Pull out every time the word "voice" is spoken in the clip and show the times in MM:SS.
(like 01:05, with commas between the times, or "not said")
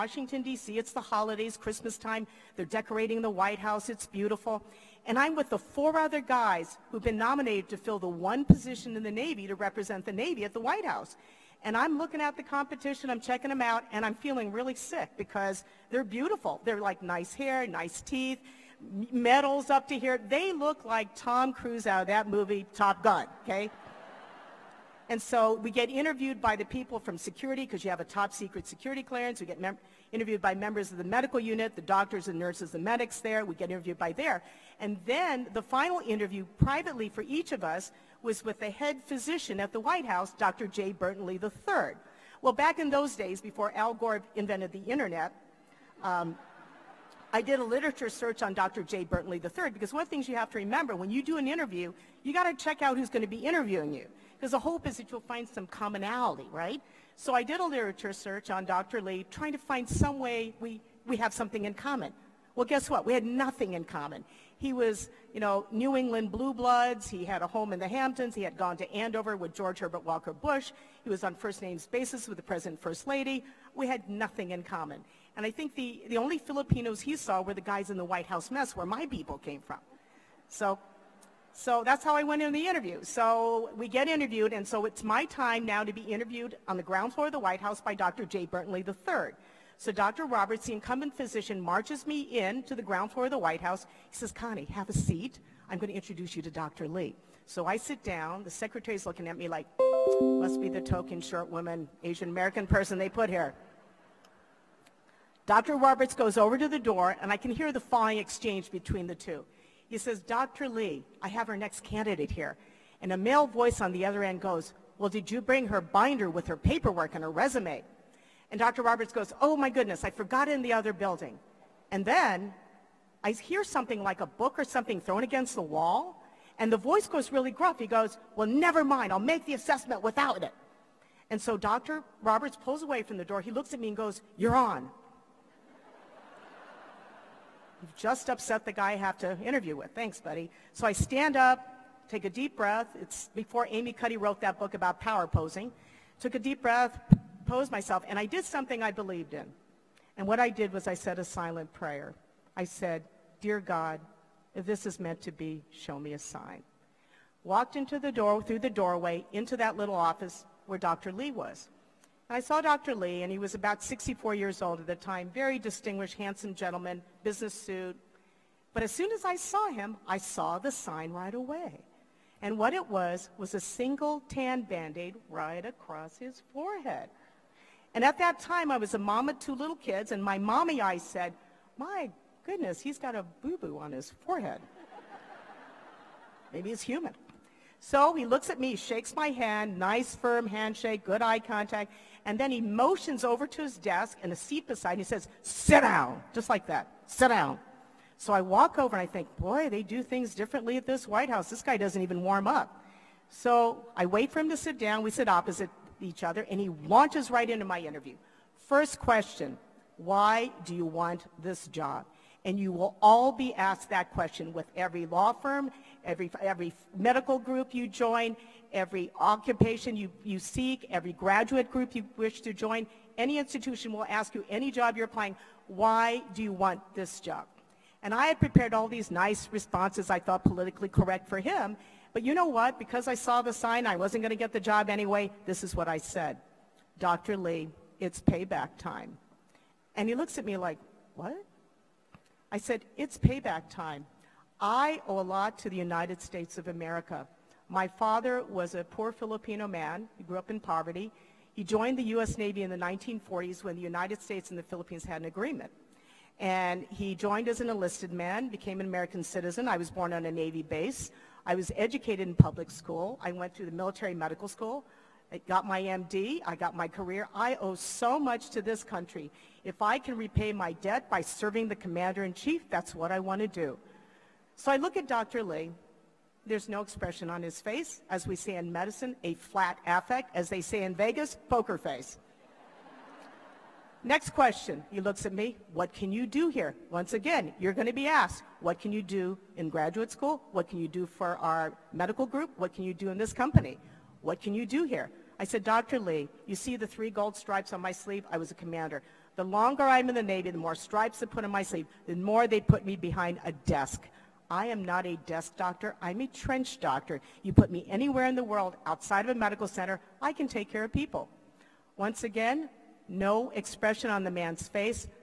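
01:53, 02:06.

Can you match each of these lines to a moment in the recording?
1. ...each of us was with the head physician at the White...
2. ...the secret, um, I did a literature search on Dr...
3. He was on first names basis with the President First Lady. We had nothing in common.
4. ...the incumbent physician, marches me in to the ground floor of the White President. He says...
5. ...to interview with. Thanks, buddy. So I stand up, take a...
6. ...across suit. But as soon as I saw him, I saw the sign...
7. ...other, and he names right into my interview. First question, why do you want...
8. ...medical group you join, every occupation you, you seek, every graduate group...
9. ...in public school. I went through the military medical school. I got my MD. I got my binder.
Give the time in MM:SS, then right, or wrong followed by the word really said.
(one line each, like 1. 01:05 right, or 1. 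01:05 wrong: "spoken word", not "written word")
1. 00:37 right
2. 00:44 wrong: "internet", not "secret"
3. 01:11 right
4. 01:30 wrong: "House", not "President"
5. 02:19 right
6. 02:47 wrong: "business", not "across"
7. 03:26 wrong: "launches", not "names"
8. 03:36 right
9. 04:22 wrong: "career", not "binder".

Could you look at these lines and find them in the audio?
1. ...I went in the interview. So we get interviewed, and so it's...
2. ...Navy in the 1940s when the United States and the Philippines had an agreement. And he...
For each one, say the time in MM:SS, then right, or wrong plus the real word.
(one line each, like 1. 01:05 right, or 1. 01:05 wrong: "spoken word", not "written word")
1. 01:22 right
2. 04:12 right.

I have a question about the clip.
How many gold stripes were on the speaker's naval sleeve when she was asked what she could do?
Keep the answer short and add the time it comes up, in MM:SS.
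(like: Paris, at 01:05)
3, at 04:56.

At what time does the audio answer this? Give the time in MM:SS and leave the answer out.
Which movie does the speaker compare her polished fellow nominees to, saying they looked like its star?
00:22.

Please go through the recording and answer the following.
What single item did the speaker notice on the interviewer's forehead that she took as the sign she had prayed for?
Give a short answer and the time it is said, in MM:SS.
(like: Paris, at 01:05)
tan band-aid, at 02:54.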